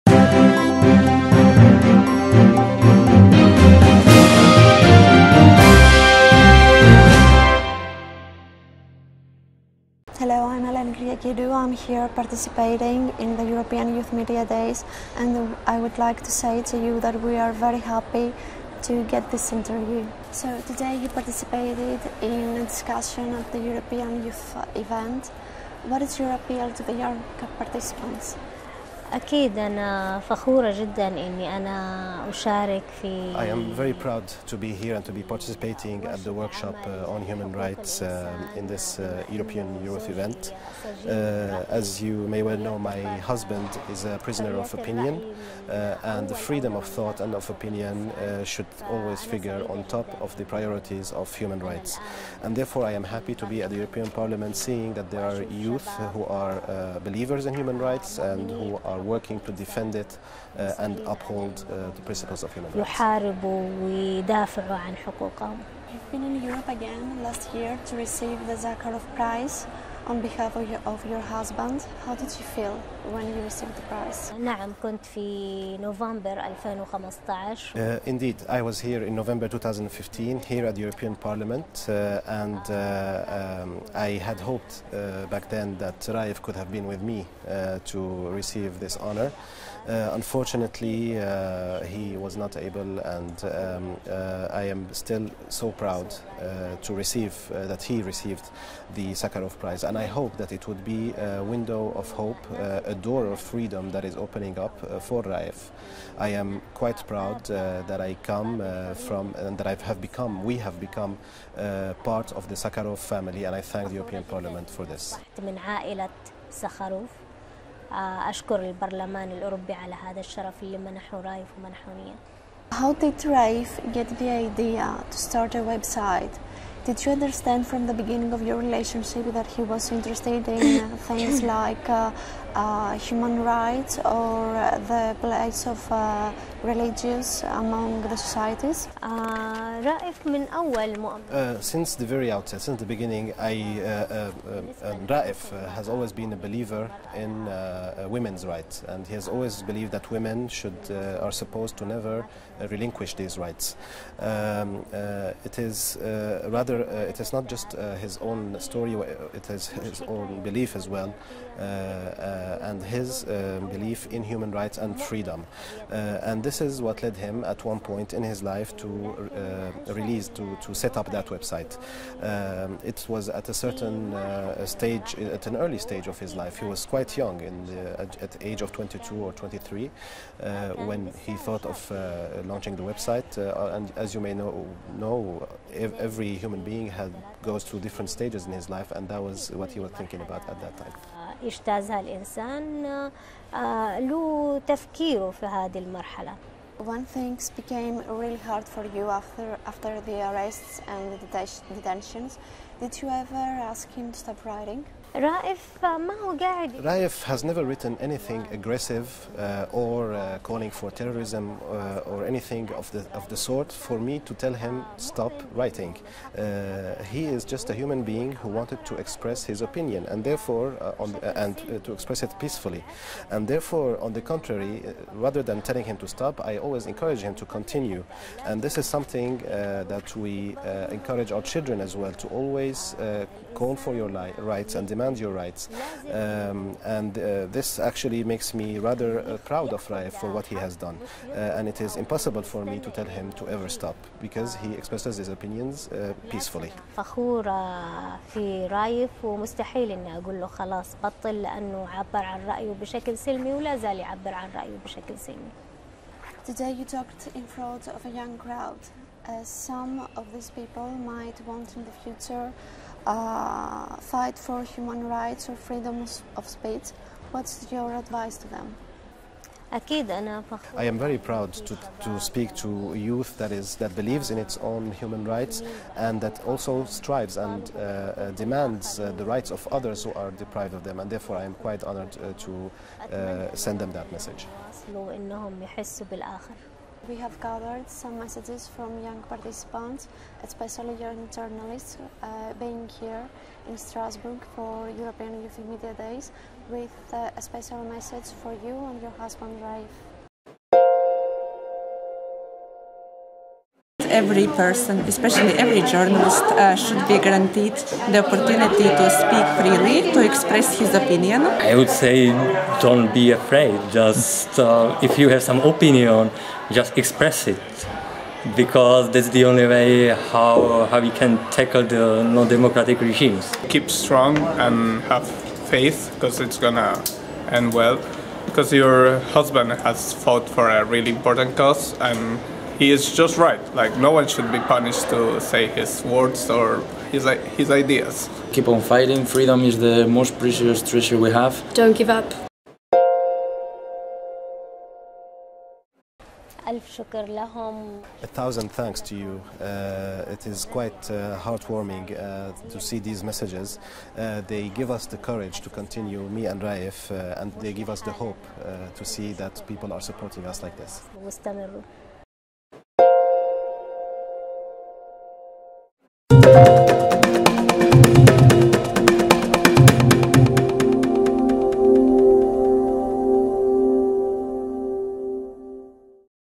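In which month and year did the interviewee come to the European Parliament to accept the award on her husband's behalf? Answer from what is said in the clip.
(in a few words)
November 2015.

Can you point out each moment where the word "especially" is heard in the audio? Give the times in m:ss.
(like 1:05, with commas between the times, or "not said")
4:50, 5:05.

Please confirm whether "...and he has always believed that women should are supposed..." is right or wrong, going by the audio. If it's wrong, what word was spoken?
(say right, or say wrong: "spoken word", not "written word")
right.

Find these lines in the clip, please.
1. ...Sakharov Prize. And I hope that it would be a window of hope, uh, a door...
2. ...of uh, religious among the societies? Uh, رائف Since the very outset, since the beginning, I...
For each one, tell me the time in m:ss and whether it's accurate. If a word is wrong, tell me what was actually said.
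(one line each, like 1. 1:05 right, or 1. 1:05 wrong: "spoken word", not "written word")
1. 1:39 right
2. 2:15 right.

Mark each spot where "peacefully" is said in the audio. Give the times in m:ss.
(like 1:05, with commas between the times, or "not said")
3:42, 4:06.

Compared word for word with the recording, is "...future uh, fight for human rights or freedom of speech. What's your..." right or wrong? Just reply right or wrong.
right.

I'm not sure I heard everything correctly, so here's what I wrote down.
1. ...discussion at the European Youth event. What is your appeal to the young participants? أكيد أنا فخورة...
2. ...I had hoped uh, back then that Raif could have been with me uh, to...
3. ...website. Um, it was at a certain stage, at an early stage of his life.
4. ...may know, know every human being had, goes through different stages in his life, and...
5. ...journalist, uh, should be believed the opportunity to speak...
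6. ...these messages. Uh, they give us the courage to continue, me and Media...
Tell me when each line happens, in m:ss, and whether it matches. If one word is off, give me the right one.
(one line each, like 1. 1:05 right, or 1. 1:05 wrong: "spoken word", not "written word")
1. 0:22 right
2. 1:23 right
3. 2:51 right
4. 3:04 right
5. 5:05 wrong: "guaranteed", not "believed"
6. 5:52 wrong: "Raif", not "Media".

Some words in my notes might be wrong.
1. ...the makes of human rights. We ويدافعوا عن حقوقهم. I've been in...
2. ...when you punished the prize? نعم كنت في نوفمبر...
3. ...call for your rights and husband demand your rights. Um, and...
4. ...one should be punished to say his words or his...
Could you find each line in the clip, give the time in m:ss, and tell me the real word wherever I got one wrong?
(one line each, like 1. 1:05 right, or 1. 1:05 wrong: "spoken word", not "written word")
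1. 1:01 wrong: "principles", not "makes"
2. 1:13 wrong: "received", not "punished"
3. 3:53 wrong: "demand", not "husband"
4. 5:34 right.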